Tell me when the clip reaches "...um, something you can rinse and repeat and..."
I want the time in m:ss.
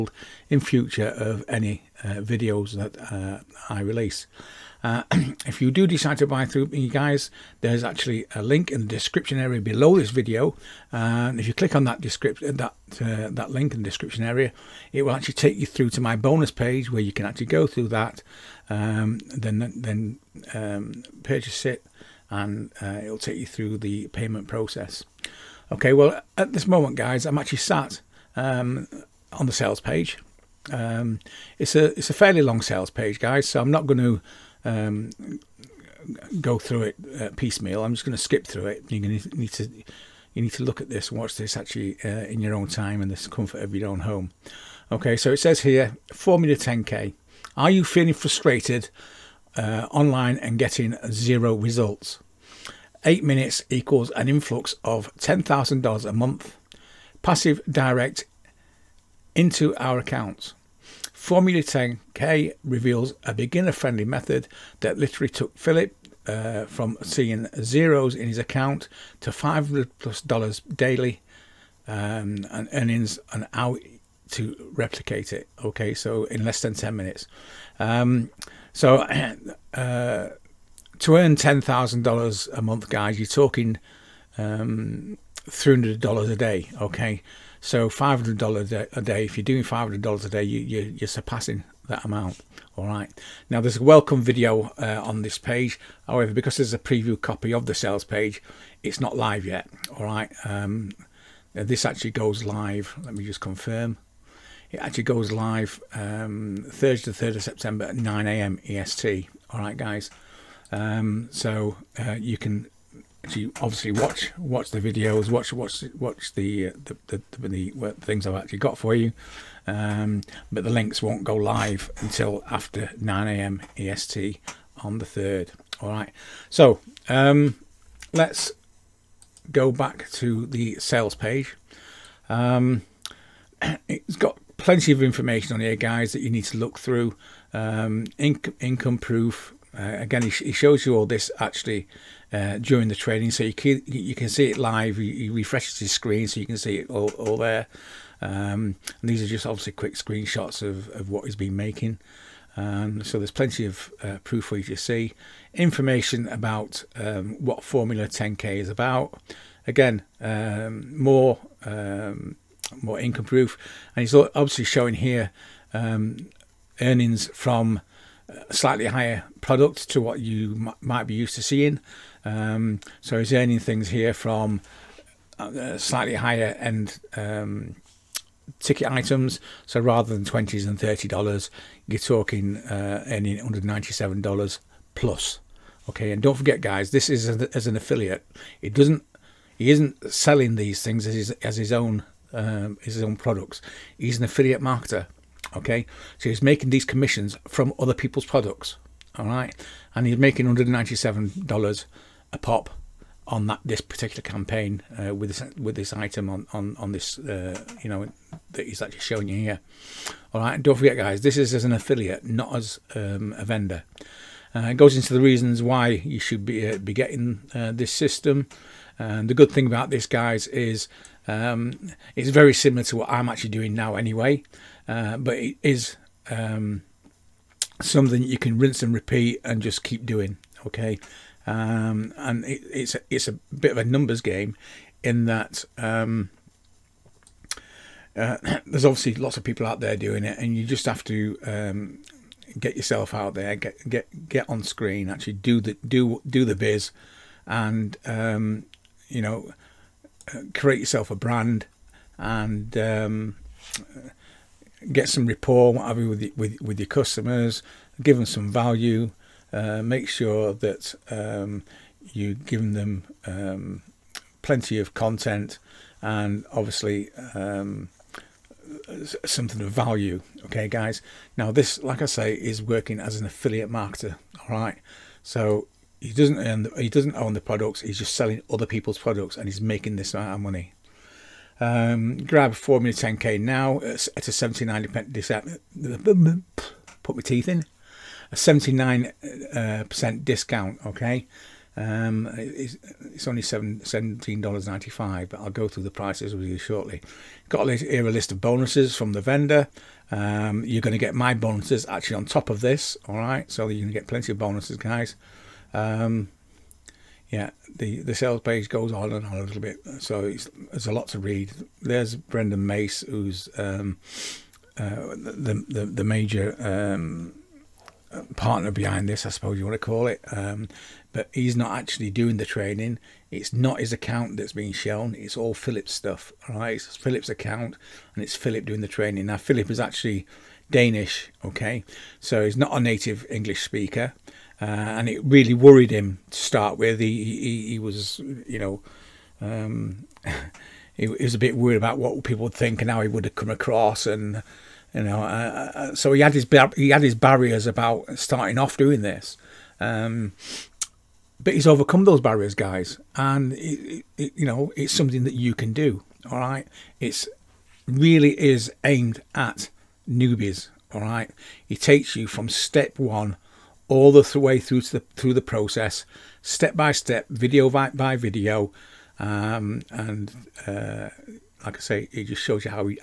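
3:46.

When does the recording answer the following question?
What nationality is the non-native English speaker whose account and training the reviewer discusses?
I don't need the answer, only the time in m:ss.
5:30.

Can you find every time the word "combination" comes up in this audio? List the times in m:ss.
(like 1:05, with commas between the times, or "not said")
not said.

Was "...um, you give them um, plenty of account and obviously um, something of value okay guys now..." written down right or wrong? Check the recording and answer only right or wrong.
wrong.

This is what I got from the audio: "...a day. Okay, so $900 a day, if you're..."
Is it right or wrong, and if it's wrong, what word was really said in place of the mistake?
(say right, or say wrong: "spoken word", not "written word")
wrong: "500", not "900".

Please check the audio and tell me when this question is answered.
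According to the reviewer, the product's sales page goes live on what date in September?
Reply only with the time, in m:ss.
1:46.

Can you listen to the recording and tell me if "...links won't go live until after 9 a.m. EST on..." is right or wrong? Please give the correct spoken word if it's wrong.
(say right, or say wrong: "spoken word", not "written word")
right.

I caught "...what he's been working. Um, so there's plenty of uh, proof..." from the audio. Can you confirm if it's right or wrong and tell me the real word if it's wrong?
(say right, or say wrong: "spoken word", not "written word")
wrong: "making", not "working".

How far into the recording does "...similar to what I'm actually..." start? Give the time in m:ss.
3:42.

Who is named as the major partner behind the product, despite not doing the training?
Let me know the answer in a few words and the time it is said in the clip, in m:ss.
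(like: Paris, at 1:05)
Brendan Mace, at 5:12.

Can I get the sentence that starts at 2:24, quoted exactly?
He, refreshes his screen so you can see it all, all there.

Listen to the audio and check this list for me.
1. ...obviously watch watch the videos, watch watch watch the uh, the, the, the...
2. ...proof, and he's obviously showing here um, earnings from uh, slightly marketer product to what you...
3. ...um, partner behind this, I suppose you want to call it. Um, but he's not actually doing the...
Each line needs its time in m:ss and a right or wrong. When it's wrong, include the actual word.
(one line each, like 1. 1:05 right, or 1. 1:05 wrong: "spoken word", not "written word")
1. 1:53 right
2. 2:43 wrong: "higher", not "marketer"
3. 5:16 right.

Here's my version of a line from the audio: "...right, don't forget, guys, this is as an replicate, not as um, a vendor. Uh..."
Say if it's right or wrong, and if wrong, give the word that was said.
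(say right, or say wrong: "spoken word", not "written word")
wrong: "affiliate", not "replicate".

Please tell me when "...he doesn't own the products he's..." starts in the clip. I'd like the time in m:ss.
4:36.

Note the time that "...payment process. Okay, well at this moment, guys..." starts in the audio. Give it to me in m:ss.
0:24.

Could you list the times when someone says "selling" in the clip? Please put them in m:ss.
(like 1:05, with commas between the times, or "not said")
3:10, 4:38.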